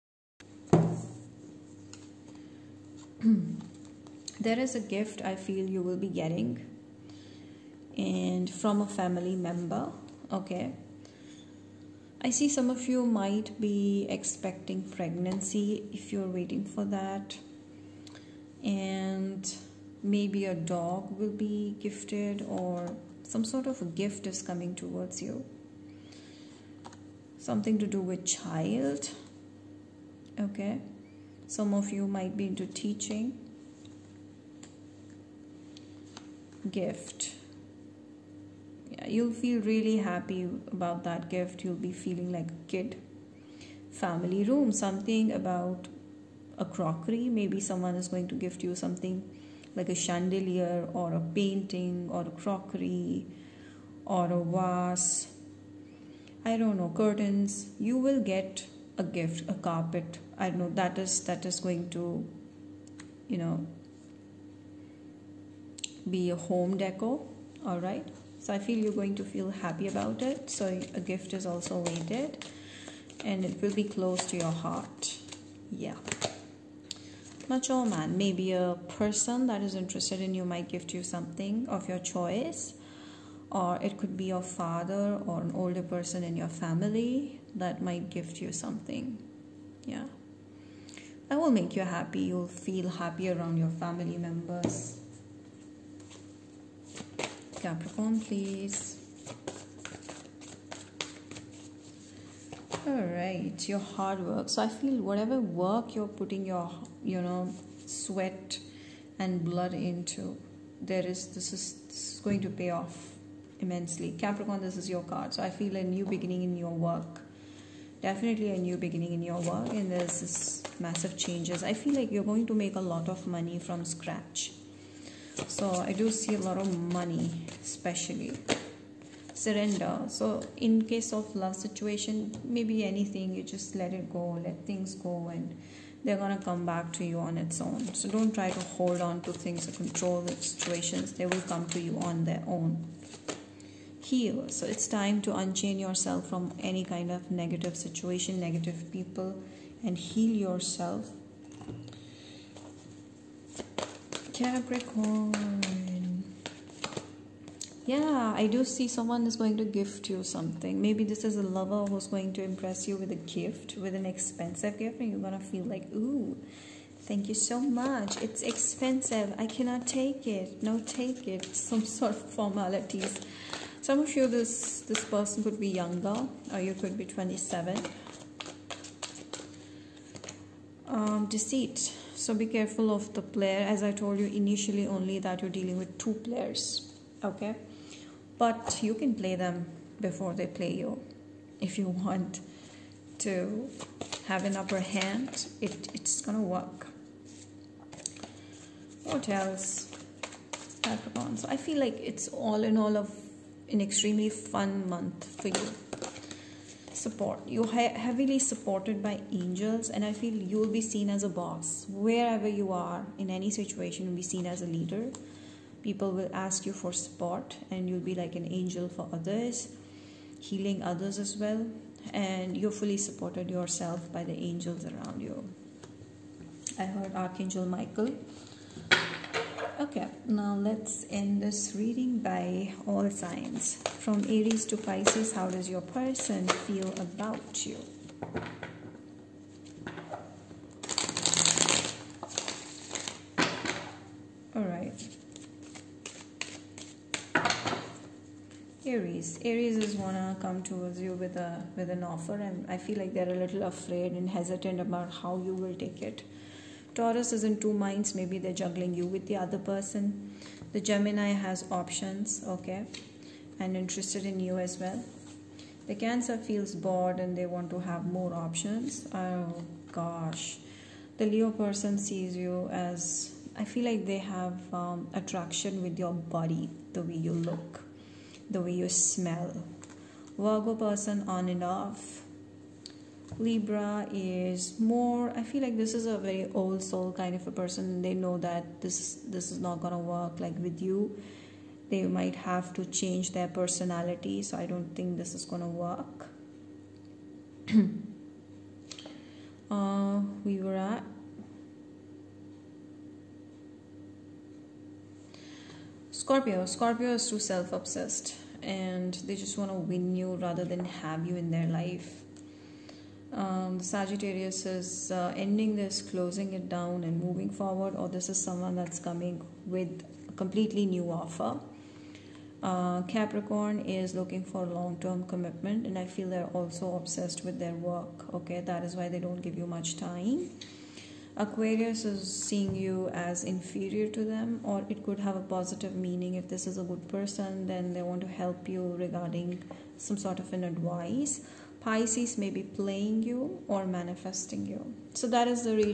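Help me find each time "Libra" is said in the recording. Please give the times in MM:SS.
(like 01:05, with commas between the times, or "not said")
04:43.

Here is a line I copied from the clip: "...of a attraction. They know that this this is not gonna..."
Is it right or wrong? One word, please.
wrong.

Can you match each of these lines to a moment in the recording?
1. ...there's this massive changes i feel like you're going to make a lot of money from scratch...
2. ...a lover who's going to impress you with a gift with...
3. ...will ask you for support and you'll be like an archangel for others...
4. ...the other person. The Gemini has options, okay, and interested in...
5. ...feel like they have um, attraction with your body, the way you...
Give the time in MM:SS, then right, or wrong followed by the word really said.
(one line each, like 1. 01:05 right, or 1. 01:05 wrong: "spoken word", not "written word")
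1. 01:59 right
2. 02:41 right
3. 03:36 wrong: "angel", not "archangel"
4. 04:19 right
5. 04:33 right.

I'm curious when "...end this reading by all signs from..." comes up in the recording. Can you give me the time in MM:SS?
03:51.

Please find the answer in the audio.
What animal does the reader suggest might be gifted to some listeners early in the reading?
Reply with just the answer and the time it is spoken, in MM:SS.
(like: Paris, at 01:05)
A dog, at 00:20.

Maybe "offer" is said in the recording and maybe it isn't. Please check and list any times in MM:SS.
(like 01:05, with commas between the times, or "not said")
04:12, 05:21.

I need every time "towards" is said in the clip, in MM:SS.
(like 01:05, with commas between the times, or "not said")
00:24, 04:10.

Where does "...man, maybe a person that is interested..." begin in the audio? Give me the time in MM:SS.
01:17.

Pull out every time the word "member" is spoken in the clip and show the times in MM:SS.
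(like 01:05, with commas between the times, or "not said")
00:09, 01:34.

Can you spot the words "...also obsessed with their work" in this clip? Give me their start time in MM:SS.
05:26.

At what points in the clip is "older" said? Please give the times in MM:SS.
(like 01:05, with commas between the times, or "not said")
01:25.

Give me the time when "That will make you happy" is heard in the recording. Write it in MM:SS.
01:31.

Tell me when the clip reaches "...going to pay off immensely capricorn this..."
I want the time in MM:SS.
01:52.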